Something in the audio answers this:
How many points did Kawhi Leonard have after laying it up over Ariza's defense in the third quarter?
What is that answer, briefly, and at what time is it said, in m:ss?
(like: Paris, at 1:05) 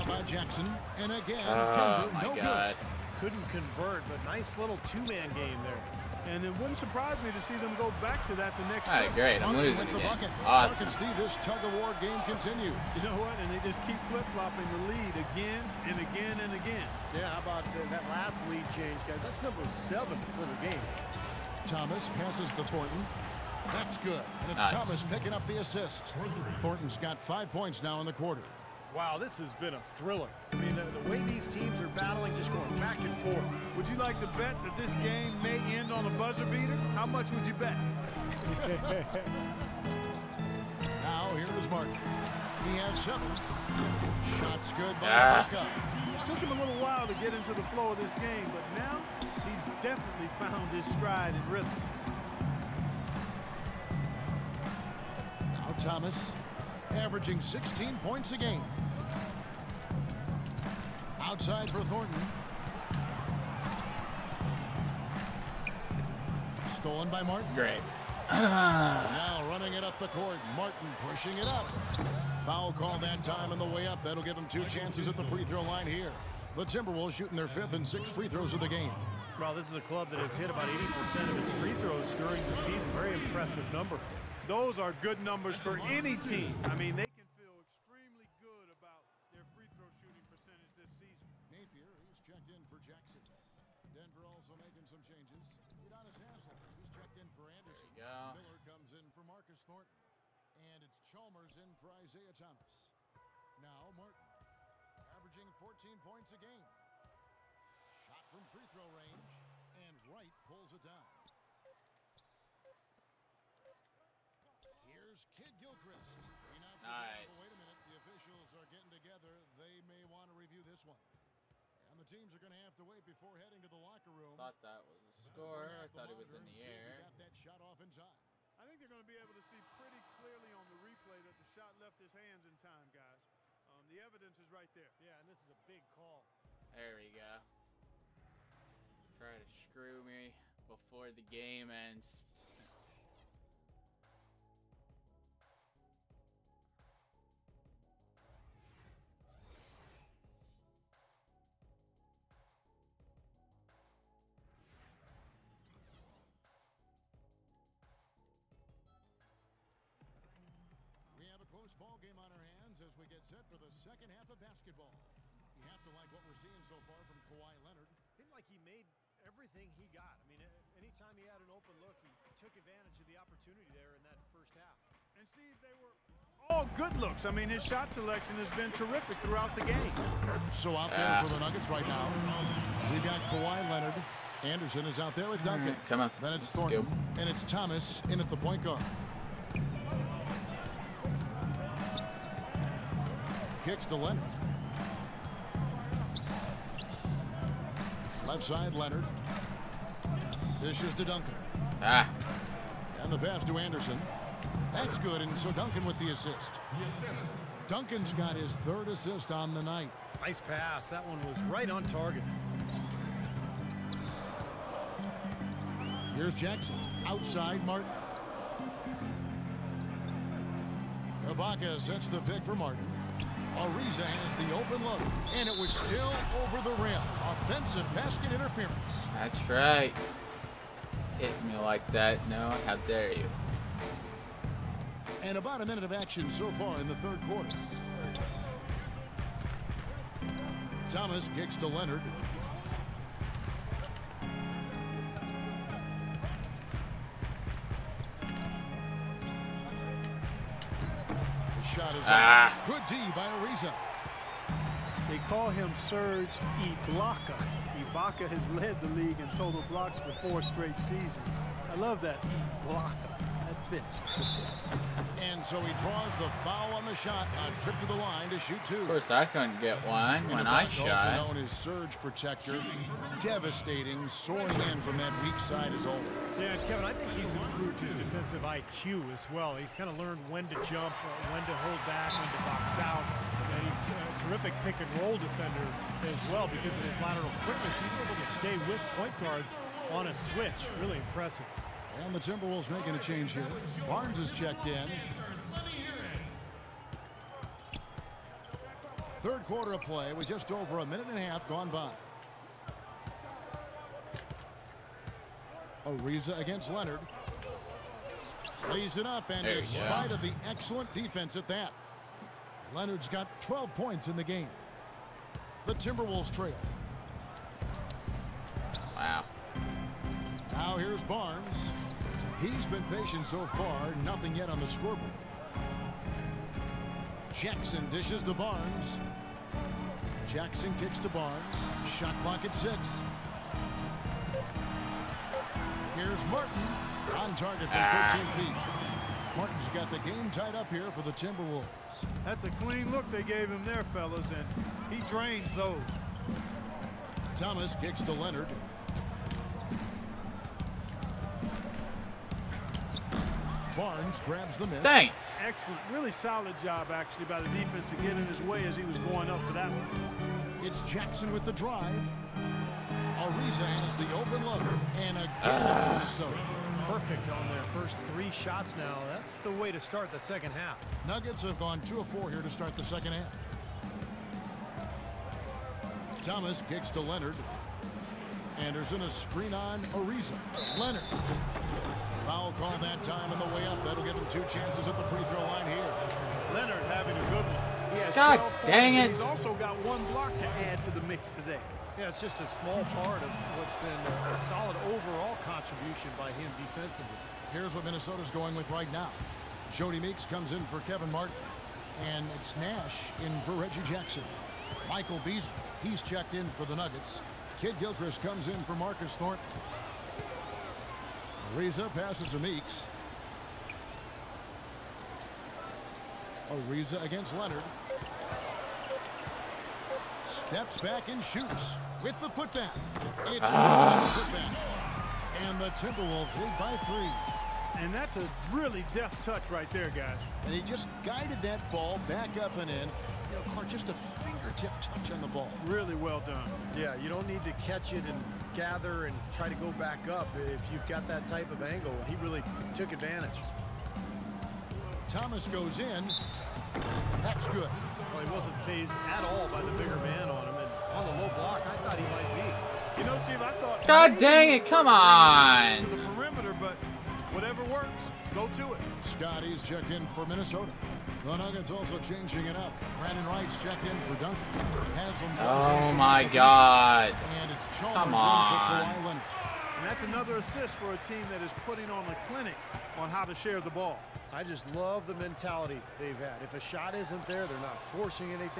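12, at 5:13.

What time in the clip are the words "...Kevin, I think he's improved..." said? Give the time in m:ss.
4:36.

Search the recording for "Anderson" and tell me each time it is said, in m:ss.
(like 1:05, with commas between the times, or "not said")
1:37, 3:04, 3:23, 6:18.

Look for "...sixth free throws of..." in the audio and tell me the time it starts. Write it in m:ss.
1:17.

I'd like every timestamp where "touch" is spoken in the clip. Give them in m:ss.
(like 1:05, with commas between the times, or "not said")
7:09, 7:14.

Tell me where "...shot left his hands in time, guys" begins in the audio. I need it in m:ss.
2:11.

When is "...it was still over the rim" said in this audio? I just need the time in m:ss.
3:45.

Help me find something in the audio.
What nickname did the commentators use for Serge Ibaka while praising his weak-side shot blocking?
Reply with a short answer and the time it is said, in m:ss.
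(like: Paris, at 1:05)
surge protector, at 4:31.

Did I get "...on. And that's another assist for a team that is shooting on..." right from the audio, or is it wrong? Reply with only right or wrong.
wrong.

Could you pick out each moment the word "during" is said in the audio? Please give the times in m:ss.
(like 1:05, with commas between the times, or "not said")
1:22.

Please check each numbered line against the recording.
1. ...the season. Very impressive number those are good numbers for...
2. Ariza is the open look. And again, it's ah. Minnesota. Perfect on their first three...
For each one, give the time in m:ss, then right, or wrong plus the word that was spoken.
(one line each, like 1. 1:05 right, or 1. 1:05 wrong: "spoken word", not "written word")
1. 1:22 right
2. 6:03 right.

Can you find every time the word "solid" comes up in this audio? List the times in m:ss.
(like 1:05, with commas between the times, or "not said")
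5:56, 6:34.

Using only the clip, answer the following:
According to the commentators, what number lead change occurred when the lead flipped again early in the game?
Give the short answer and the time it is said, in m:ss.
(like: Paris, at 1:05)
7, at 0:19.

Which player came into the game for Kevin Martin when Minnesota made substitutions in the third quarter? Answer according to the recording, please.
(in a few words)
Jodie Meeks.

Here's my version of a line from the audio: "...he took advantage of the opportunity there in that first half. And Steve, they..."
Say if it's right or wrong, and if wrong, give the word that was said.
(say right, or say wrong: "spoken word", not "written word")
right.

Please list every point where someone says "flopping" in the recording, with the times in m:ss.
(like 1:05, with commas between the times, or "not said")
0:14.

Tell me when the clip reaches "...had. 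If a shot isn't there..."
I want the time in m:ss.
7:56.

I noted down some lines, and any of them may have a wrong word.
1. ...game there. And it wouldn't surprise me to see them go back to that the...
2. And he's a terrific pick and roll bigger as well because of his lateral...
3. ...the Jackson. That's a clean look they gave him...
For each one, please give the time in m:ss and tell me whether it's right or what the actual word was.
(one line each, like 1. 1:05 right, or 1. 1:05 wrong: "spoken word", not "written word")
1. 0:05 right
2. 4:43 wrong: "defender", not "bigger"
3. 5:41 wrong: "Timberwolves", not "Jackson".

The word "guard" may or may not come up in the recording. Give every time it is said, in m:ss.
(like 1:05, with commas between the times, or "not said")
3:08, 4:49.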